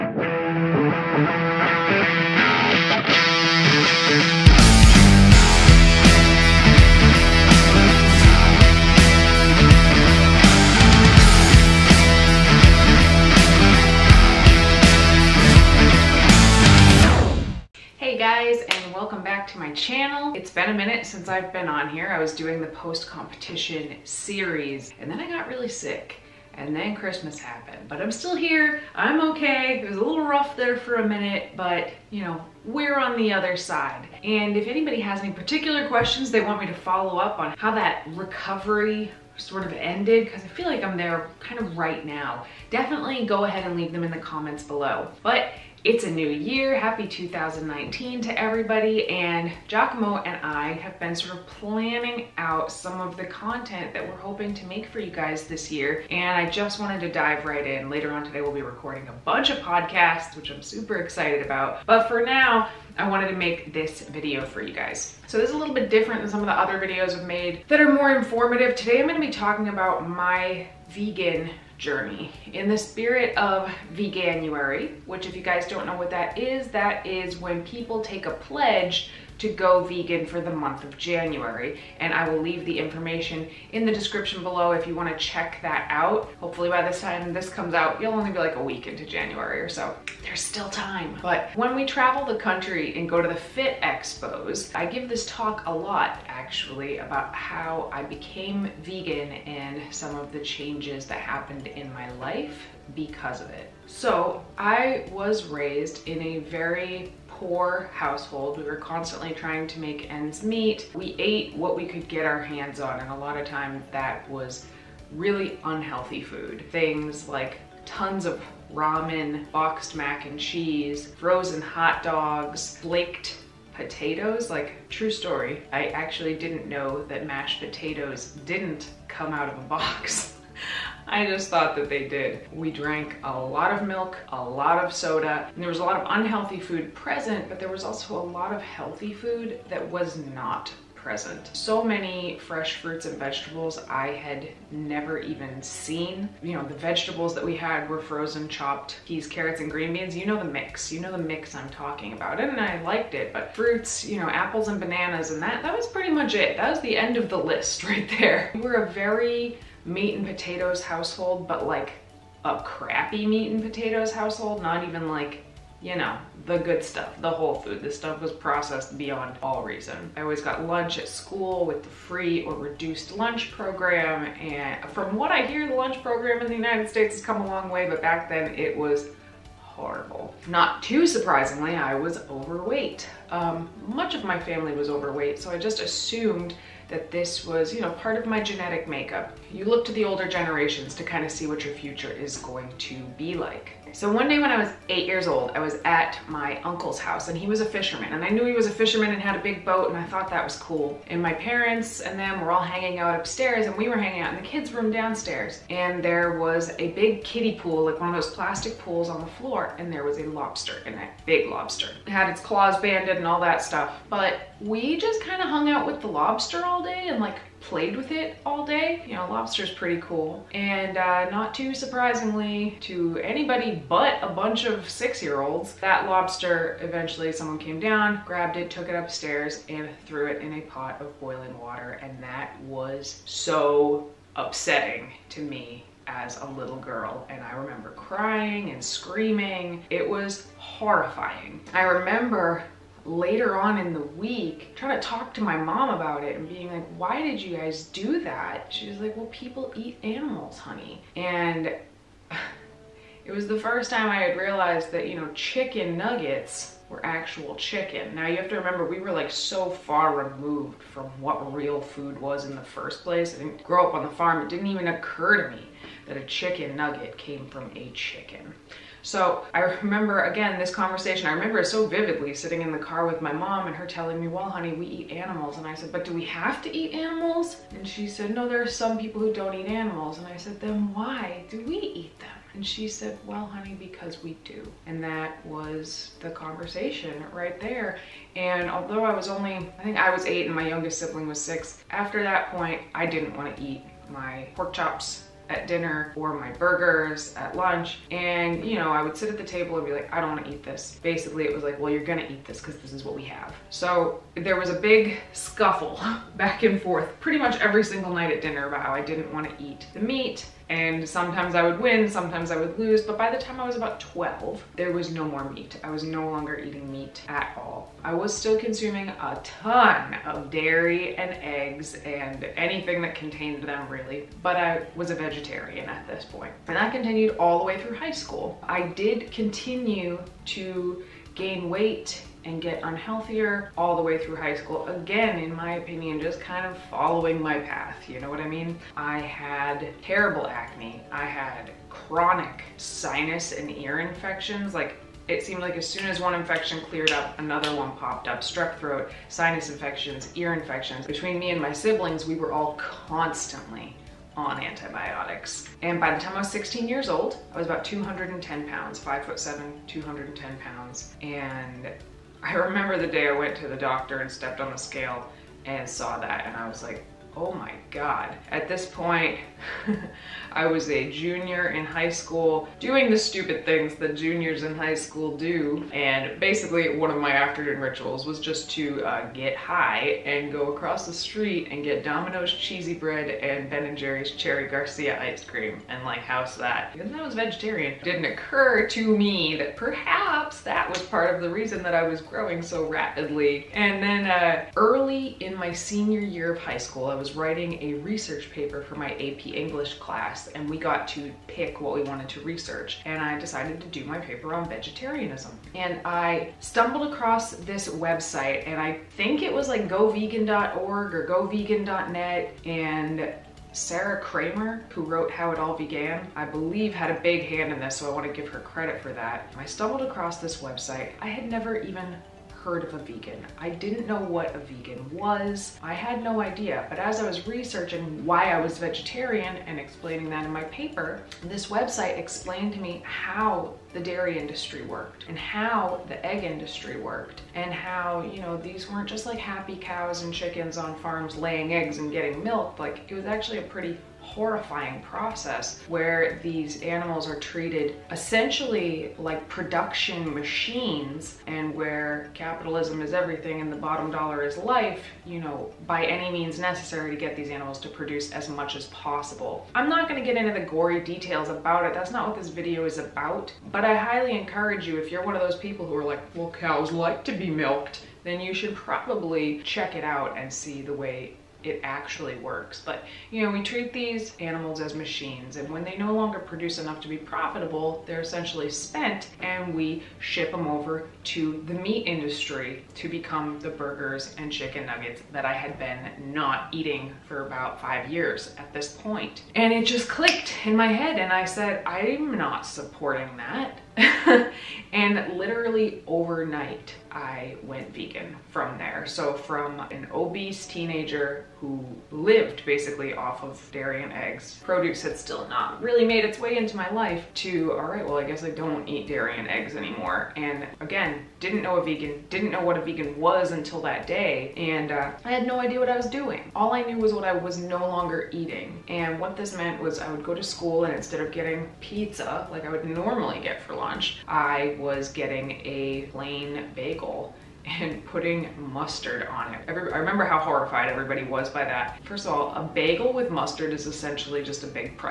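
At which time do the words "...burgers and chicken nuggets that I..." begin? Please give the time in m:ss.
8:03.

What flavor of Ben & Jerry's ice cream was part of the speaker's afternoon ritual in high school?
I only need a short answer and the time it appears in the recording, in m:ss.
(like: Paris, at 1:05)
Cherry Garcia, at 6:24.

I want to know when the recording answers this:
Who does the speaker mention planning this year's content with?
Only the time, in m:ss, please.
0:49.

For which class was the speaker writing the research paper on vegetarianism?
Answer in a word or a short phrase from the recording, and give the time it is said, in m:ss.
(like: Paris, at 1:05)
AP English, at 6:39.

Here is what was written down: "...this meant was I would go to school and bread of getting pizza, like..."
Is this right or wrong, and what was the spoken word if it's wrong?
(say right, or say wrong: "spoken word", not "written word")
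wrong: "instead", not "bread".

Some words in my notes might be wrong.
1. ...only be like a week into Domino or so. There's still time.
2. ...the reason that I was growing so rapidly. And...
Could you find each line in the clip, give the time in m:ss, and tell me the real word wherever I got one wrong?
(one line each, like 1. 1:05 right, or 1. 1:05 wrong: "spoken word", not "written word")
1. 1:28 wrong: "January", not "Domino"
2. 6:31 right.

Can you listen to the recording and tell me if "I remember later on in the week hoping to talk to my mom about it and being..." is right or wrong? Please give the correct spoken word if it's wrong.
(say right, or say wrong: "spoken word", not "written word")
wrong: "trying", not "hoping".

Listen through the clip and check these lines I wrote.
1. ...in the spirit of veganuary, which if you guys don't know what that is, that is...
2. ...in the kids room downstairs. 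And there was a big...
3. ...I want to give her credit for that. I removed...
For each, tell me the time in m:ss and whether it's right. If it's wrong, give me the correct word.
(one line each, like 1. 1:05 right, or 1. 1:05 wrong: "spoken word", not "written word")
1. 1:12 right
2. 3:24 right
3. 6:58 wrong: "stumbled", not "removed".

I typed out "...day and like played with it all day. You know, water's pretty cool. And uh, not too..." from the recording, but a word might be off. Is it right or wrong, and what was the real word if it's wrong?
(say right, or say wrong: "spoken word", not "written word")
wrong: "lobster", not "water".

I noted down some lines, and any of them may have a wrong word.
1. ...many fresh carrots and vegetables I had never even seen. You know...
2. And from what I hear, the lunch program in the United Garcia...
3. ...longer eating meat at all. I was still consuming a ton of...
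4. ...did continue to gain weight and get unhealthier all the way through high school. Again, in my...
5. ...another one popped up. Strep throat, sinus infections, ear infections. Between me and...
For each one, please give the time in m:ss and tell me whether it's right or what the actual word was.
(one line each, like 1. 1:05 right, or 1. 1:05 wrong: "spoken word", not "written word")
1. 2:21 wrong: "fruits", not "carrots"
2. 2:54 wrong: "States", not "Garcia"
3. 5:16 right
4. 5:28 right
5. 5:47 right.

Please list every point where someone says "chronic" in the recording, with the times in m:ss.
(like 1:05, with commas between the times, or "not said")
5:41.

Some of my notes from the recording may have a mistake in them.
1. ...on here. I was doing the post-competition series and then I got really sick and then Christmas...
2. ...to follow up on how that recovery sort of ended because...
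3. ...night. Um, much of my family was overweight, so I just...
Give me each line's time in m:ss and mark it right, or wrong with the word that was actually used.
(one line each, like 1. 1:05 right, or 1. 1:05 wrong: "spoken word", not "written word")
1. 0:21 right
2. 0:36 right
3. 3:02 wrong: "overweight", not "night".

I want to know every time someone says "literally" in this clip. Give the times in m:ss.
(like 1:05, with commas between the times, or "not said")
8:15.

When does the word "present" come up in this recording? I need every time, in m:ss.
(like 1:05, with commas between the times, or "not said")
2:16, 2:20.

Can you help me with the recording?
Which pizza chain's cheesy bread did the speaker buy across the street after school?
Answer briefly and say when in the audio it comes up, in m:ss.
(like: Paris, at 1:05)
Domino's, at 6:22.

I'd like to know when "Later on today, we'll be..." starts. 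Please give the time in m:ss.
0:57.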